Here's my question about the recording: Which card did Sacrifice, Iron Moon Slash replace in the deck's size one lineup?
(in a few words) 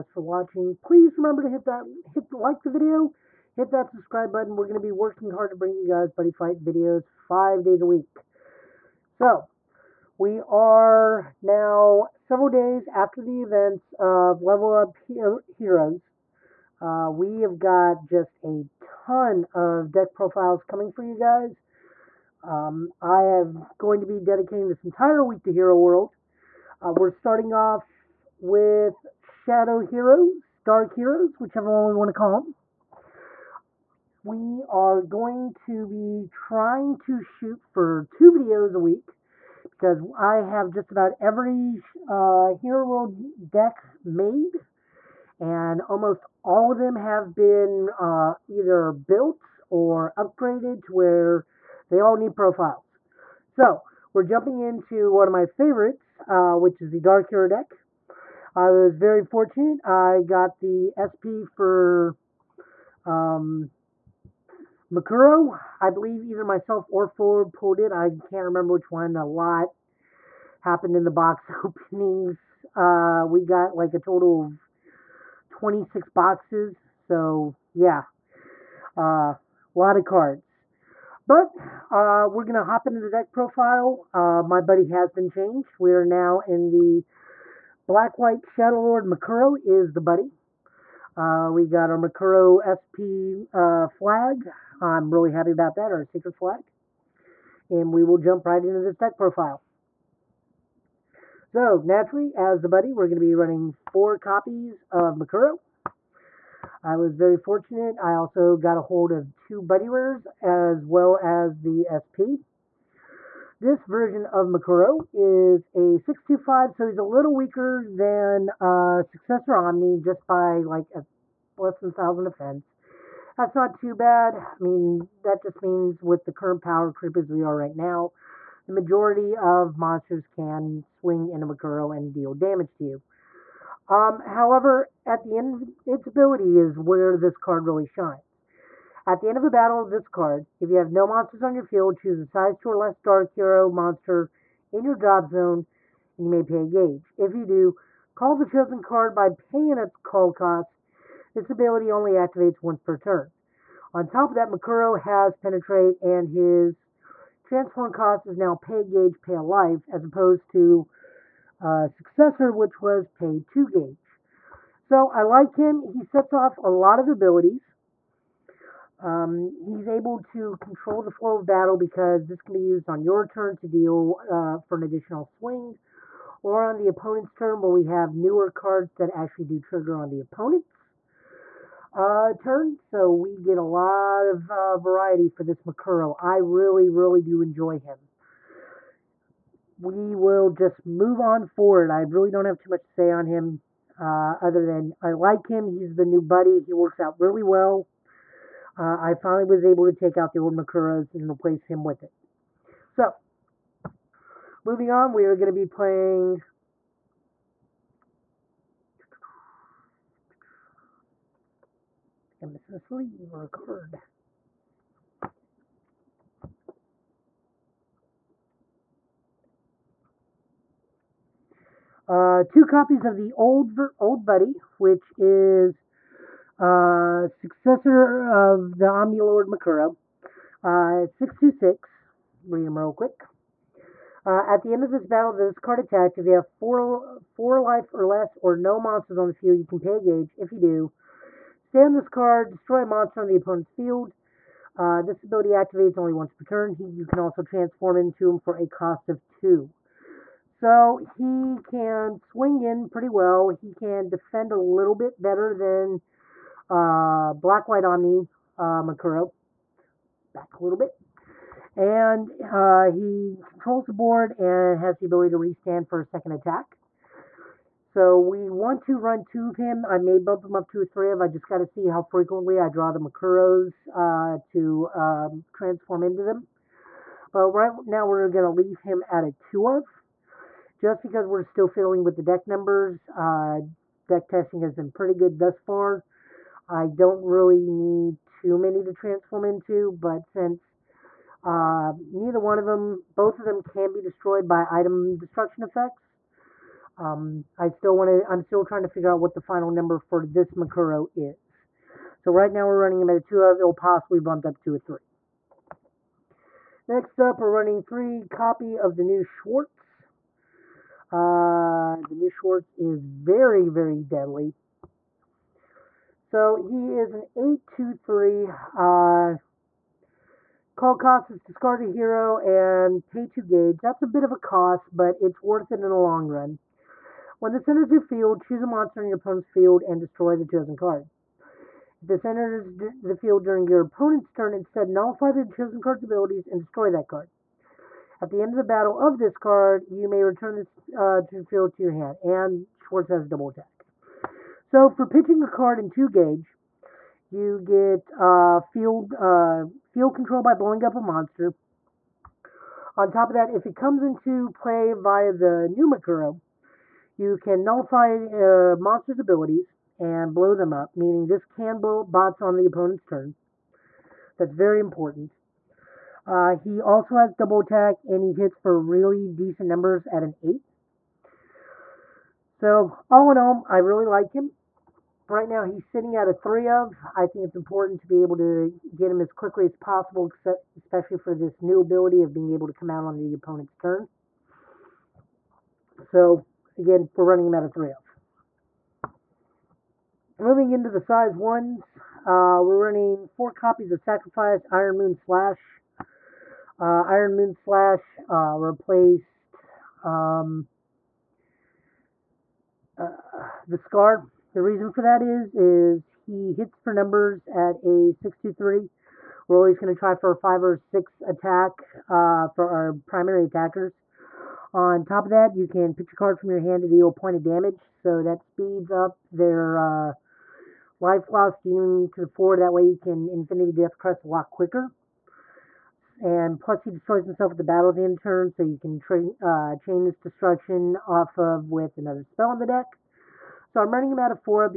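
The scar.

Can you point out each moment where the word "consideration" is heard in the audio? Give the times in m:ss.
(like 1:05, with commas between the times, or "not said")
not said.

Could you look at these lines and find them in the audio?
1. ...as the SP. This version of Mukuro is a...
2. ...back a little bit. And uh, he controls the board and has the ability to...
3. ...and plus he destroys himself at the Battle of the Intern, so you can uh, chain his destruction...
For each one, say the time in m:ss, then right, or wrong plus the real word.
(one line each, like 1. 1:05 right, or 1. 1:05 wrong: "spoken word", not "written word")
1. 1:51 right
2. 4:20 right
3. 7:06 right.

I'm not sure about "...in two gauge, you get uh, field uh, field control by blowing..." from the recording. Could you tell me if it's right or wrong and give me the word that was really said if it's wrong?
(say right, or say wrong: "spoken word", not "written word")
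right.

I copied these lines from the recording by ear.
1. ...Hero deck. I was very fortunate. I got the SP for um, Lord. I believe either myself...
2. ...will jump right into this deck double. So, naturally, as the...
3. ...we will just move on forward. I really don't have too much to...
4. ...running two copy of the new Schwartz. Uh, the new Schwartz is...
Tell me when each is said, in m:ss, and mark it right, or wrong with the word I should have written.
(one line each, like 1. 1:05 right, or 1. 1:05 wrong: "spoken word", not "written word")
1. 0:57 wrong: "Mukuro", not "Lord"
2. 1:38 wrong: "profile", not "double"
3. 3:09 right
4. 5:07 wrong: "three", not "two".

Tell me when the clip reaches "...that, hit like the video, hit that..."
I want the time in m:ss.
0:01.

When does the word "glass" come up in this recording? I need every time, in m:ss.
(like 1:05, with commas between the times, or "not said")
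not said.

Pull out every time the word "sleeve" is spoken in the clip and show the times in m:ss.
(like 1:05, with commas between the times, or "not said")
3:32.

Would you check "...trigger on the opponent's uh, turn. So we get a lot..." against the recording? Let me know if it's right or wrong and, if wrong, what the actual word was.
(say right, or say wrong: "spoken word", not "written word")
right.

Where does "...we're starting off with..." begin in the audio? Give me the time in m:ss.
0:26.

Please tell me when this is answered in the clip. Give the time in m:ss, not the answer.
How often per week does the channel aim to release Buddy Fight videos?
0:07.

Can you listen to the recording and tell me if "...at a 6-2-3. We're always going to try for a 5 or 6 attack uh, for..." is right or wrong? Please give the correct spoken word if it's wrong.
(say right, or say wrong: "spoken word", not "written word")
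right.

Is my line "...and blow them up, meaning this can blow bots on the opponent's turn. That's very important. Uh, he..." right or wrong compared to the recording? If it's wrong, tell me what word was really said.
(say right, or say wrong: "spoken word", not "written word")
right.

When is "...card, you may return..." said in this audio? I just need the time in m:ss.
5:39.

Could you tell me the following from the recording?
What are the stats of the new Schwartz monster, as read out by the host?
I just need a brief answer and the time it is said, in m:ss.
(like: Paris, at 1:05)
8-2-3, at 5:17.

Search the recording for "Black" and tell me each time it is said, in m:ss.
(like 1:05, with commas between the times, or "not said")
1:27, 4:17.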